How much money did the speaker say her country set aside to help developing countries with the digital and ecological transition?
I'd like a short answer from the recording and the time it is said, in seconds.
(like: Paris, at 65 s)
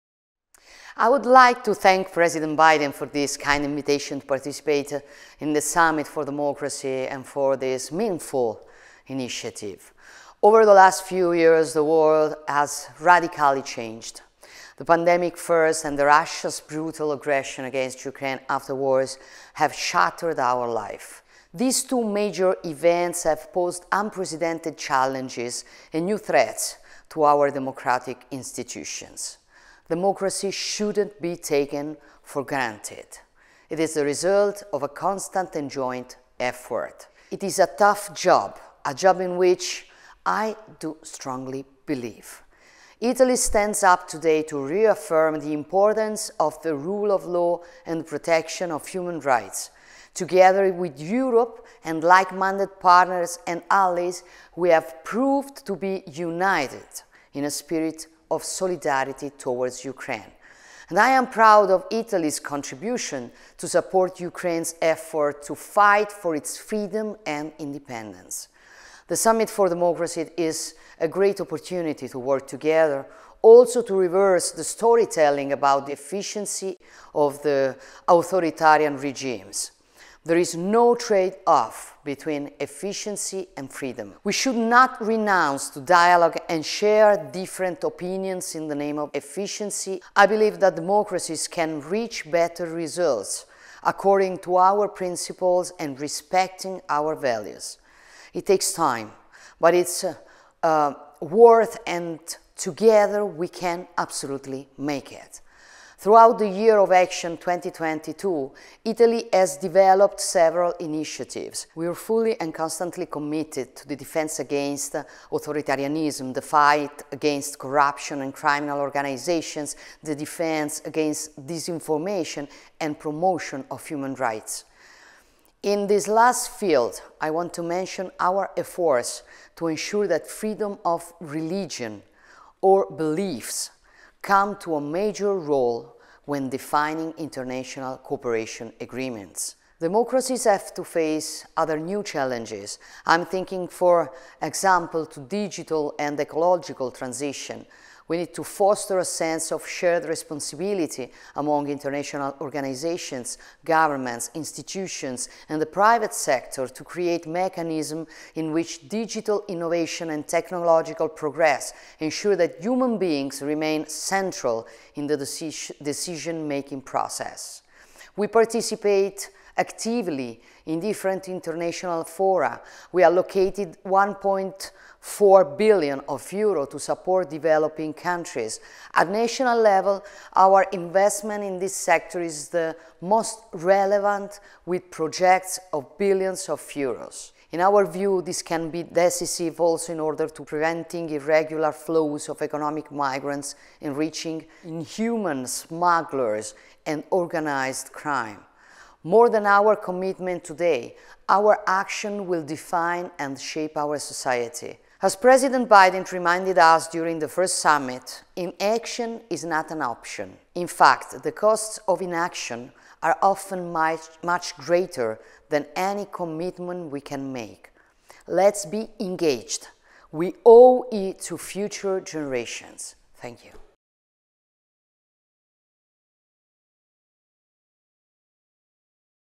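1.4 billion euros, at 173 s.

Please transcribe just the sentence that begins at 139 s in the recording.
Democracies have to face other new challenges.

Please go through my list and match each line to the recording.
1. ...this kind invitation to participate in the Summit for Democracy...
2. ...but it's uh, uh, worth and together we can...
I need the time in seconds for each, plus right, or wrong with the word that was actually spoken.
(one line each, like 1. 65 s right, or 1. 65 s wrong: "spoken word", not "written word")
1. 3 s right
2. 99 s right.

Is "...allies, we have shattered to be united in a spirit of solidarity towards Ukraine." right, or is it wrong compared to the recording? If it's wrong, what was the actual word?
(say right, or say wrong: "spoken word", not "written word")
wrong: "proved", not "shattered".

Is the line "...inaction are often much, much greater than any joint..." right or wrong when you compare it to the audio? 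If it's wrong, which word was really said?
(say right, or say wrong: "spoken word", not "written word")
wrong: "commitment", not "joint".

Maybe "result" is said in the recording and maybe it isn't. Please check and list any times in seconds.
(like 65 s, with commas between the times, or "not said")
34 s, 92 s.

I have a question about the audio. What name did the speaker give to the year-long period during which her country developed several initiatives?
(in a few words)
Year of Action 2022.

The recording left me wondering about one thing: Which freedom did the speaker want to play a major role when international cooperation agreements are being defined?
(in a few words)
freedom of religion or beliefs.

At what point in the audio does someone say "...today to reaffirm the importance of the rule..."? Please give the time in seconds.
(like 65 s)
44 s.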